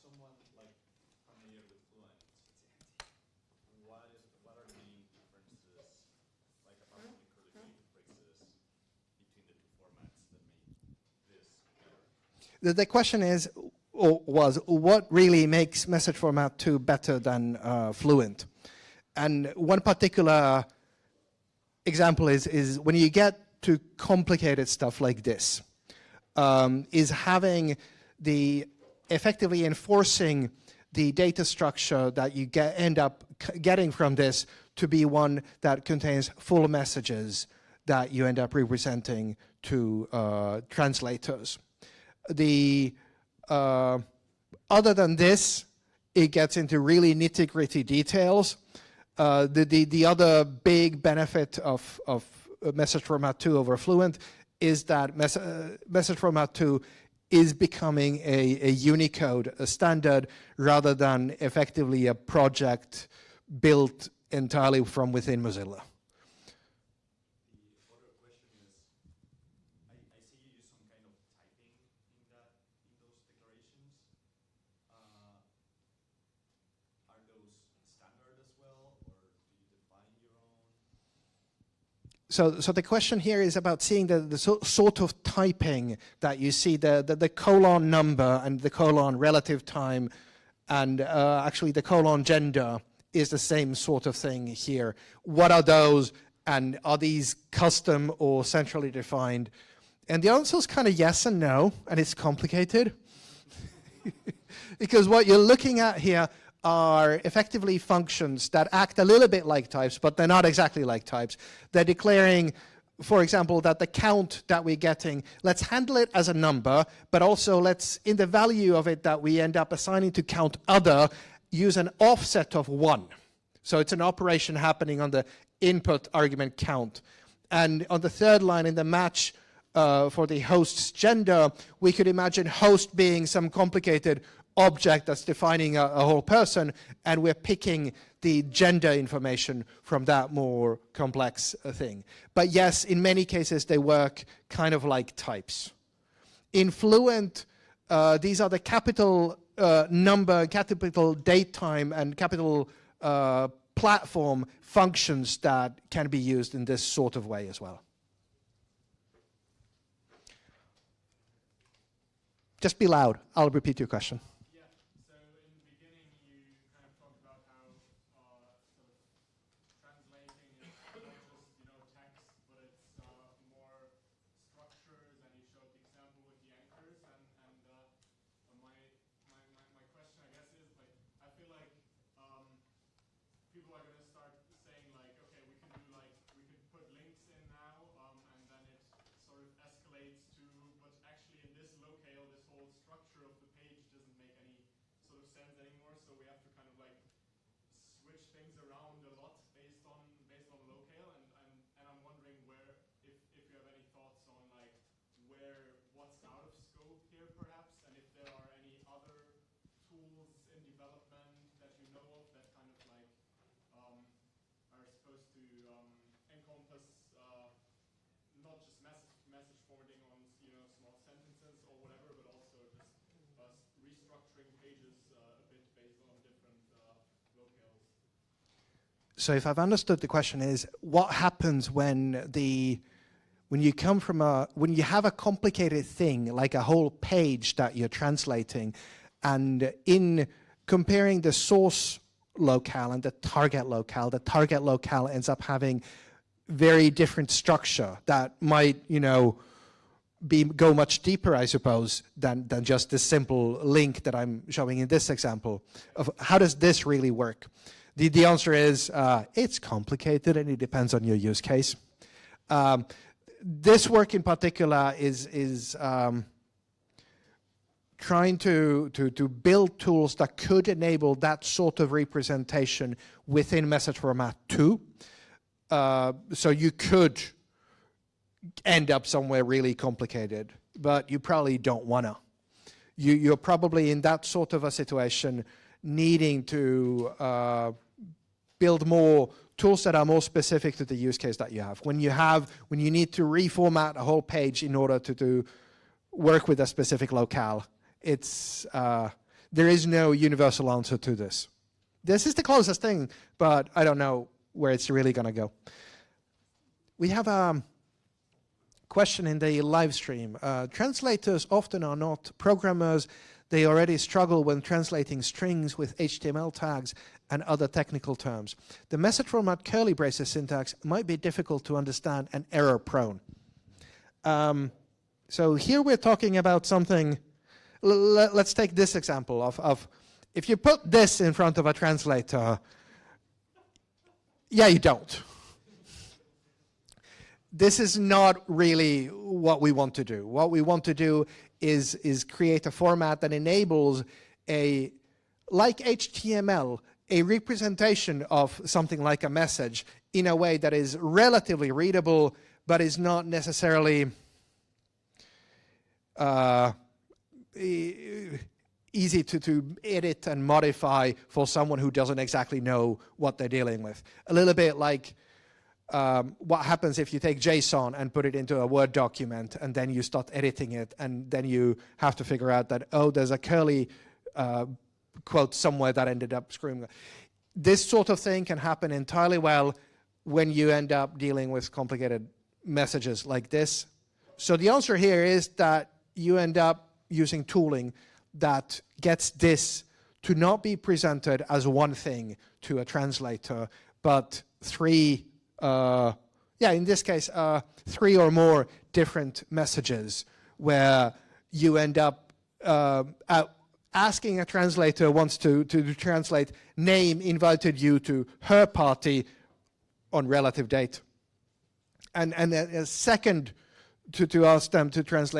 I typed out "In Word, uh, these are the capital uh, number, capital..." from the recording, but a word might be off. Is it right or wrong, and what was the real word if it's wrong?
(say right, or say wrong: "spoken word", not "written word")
wrong: "Fluent", not "Word".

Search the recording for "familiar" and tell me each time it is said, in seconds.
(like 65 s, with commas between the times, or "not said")
1 s.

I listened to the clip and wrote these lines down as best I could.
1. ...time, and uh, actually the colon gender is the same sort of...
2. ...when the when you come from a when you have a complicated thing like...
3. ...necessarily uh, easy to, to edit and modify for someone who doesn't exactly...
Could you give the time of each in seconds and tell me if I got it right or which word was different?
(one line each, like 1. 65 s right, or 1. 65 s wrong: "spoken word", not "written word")
1. 89 s right
2. 231 s right
3. 353 s right.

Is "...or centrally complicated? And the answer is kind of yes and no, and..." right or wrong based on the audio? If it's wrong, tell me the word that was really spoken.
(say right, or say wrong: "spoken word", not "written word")
wrong: "defined", not "complicated".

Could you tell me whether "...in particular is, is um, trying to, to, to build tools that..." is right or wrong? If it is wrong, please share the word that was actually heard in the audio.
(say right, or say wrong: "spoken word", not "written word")
right.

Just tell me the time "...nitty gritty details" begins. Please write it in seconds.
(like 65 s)
47 s.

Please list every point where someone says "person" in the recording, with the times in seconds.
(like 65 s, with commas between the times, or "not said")
136 s.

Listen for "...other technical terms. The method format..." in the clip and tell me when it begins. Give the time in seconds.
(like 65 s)
317 s.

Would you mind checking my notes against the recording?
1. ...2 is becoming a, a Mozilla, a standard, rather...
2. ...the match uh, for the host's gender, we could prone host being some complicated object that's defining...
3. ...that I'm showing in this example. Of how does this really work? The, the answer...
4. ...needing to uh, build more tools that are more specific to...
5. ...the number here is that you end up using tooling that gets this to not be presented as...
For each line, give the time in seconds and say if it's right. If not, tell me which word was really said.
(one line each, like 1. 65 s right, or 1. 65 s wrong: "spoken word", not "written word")
1. 56 s wrong: "Unicode", not "Mozilla"
2. 128 s wrong: "imagine", not "prone"
3. 254 s right
4. 285 s right
5. 384 s wrong: "answer", not "number".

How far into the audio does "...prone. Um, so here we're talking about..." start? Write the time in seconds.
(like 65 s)
322 s.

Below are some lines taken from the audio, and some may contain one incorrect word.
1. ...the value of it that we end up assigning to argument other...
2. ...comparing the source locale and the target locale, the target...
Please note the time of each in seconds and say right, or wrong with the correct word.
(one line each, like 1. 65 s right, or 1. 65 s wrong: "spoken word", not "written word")
1. 118 s wrong: "count", not "argument"
2. 240 s right.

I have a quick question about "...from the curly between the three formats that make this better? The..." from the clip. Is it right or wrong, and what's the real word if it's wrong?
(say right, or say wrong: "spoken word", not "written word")
wrong: "two", not "three".